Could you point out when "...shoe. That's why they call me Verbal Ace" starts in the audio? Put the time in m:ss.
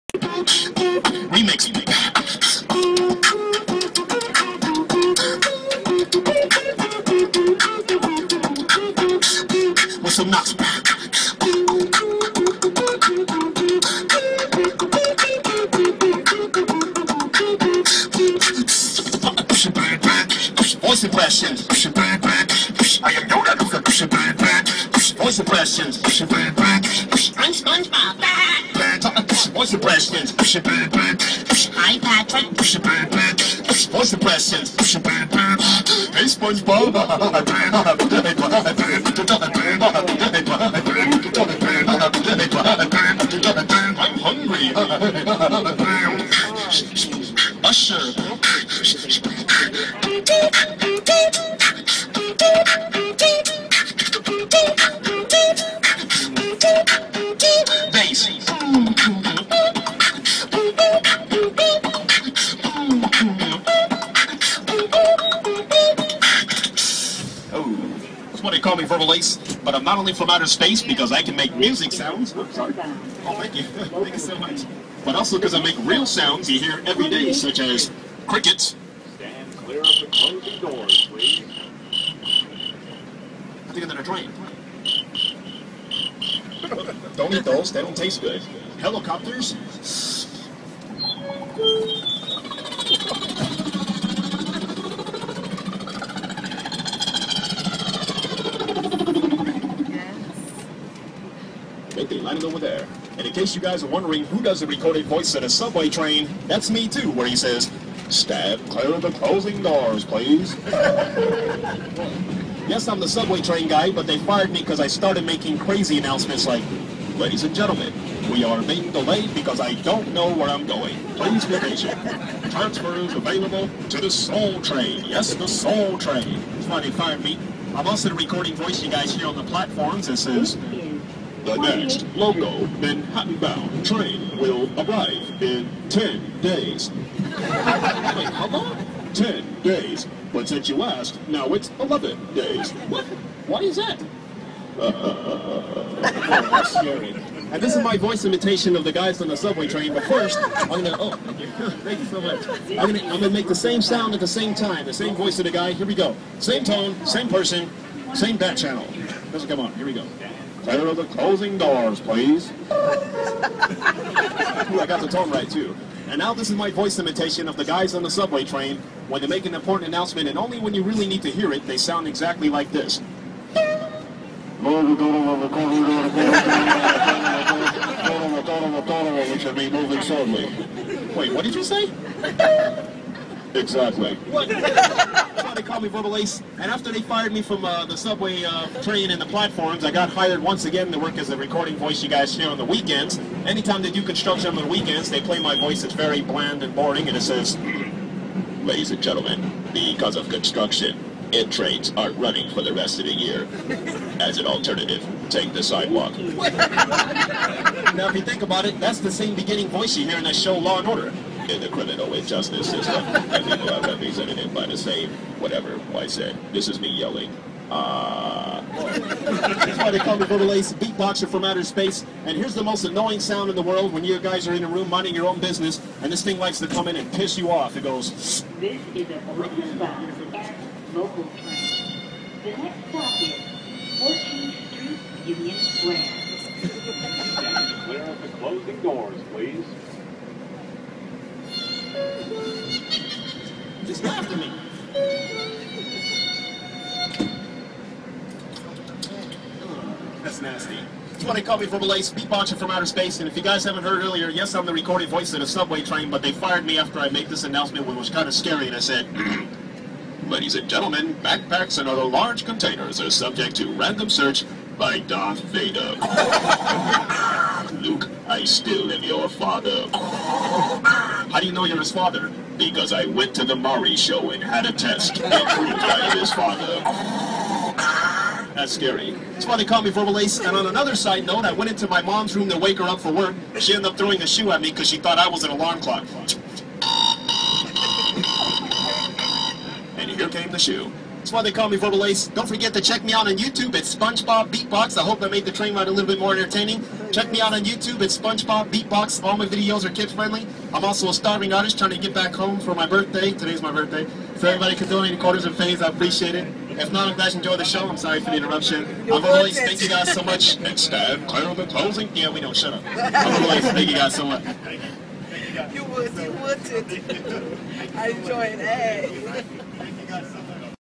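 4:50.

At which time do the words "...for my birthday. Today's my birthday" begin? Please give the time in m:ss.
5:02.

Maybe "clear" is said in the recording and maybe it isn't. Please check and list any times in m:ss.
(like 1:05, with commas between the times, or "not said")
1:19, 1:48, 2:40, 3:57, 5:11.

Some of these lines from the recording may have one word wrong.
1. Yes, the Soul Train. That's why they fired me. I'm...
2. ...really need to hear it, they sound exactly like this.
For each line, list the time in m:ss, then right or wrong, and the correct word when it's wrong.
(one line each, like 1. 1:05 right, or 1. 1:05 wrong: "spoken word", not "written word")
1. 2:05 right
2. 2:50 right.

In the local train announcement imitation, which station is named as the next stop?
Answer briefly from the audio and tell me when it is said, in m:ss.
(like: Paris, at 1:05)
14th Street, Union Square, at 3:53.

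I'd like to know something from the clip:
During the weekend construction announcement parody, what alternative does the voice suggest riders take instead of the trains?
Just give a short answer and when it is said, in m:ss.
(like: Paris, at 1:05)
the sidewalk, at 3:25.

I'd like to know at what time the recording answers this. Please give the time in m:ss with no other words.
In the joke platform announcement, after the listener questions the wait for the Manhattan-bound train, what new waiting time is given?
2:21.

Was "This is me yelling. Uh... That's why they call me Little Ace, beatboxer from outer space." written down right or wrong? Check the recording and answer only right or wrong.
right.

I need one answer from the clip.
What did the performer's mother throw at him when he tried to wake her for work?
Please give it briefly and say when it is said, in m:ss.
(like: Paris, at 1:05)
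alarm clock, at 4:45.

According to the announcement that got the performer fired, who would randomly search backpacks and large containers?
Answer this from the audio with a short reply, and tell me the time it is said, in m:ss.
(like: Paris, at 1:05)
Darth Vader, at 4:24.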